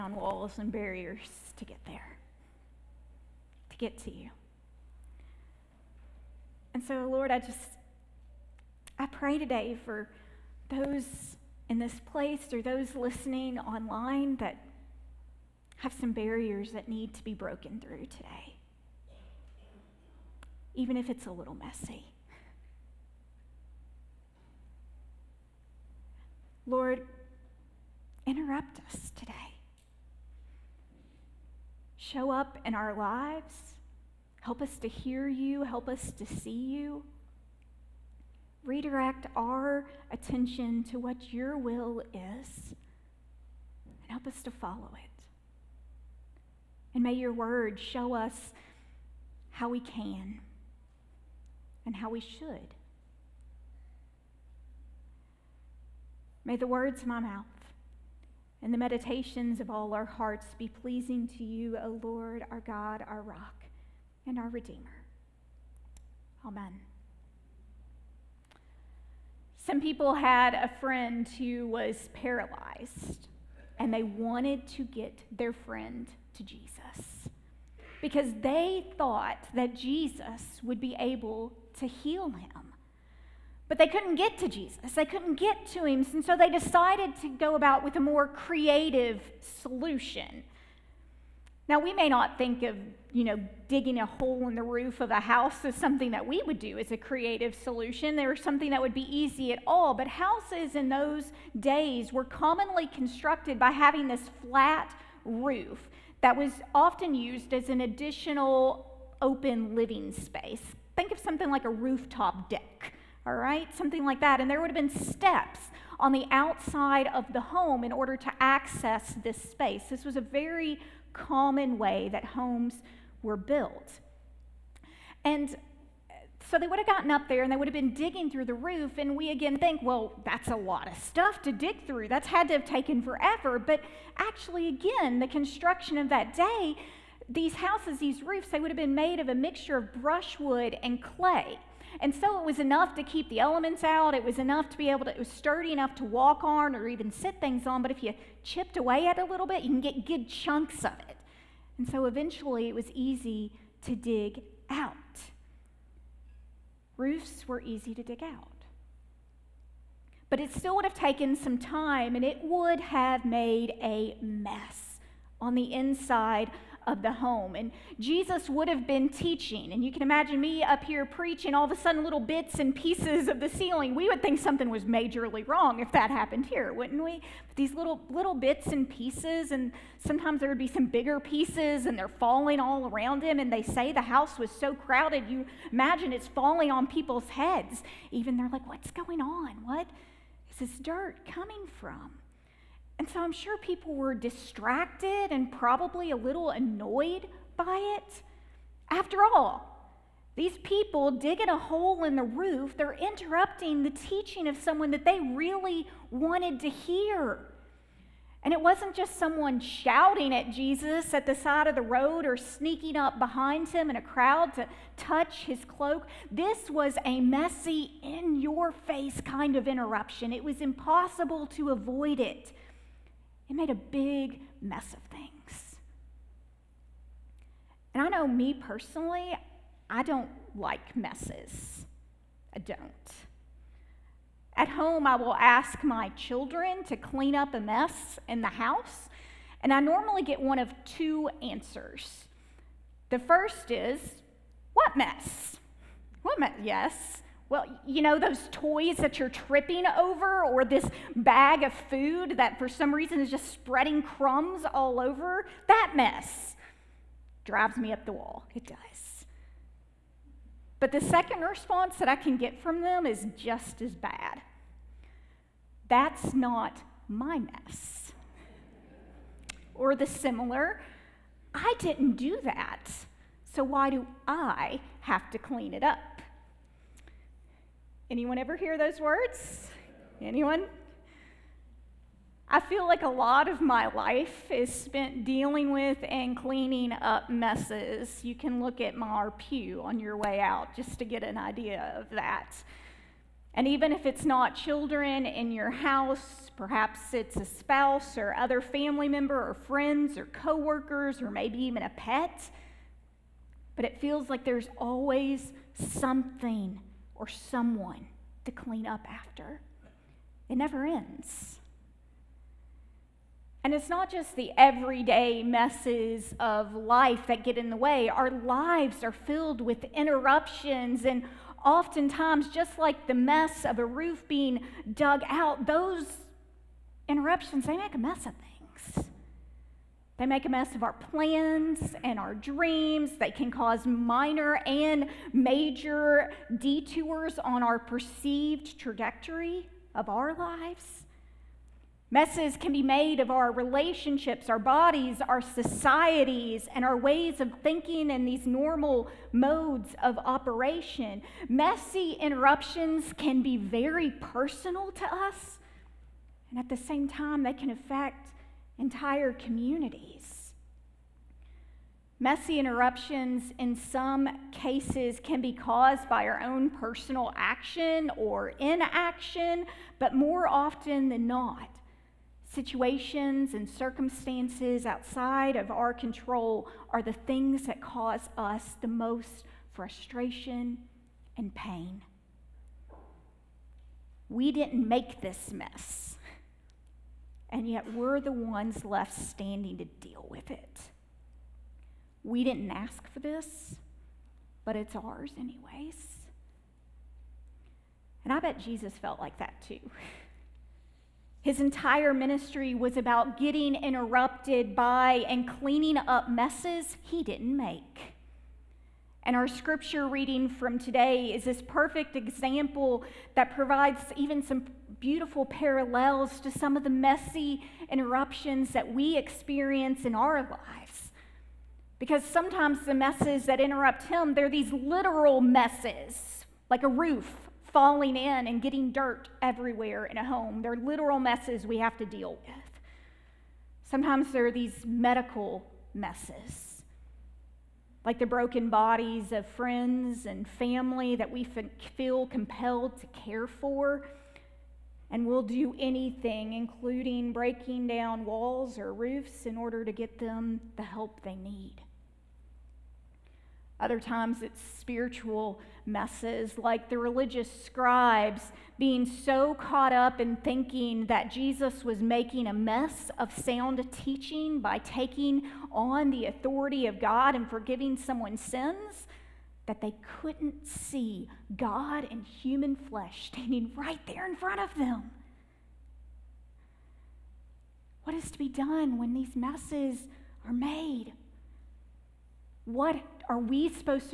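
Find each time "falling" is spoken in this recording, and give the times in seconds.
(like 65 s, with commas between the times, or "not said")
182 s, 186 s, 427 s.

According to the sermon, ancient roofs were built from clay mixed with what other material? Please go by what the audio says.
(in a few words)
brushwood.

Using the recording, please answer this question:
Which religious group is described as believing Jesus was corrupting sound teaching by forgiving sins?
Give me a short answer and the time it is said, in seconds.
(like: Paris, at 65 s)
scribes, at 457 s.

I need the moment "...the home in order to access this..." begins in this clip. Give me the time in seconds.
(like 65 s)
117 s.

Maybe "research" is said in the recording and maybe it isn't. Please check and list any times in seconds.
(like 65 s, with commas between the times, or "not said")
not said.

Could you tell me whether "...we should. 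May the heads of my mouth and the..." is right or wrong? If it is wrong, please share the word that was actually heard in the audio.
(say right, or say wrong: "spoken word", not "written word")
wrong: "words", not "heads".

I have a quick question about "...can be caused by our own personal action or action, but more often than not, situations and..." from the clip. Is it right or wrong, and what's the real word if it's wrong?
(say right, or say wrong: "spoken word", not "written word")
wrong: "inaction", not "action".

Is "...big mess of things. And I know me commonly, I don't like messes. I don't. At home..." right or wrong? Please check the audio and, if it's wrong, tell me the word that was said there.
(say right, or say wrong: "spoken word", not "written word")
wrong: "personally", not "commonly".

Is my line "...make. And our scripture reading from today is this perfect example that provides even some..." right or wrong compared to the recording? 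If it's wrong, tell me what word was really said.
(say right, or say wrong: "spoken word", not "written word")
right.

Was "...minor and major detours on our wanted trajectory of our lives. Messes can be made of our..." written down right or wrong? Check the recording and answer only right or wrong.
wrong.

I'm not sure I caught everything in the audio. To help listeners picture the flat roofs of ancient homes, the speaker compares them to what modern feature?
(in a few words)
rooftop deck.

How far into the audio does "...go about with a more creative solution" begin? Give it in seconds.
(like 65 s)
87 s.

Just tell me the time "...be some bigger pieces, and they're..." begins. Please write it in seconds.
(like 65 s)
180 s.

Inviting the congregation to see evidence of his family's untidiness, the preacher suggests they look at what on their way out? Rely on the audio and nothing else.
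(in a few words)
my pew.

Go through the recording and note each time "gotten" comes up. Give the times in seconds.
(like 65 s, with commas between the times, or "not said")
126 s.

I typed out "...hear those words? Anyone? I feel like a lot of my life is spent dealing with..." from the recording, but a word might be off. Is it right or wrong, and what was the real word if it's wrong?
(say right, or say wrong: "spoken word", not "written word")
right.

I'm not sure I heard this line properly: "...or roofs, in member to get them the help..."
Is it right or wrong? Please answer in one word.
wrong.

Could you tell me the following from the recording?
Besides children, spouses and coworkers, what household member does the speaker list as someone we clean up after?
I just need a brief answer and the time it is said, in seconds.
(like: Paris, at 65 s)
a pet, at 301 s.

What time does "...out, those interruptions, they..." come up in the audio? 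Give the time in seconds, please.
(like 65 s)
325 s.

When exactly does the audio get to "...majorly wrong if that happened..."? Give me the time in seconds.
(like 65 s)
174 s.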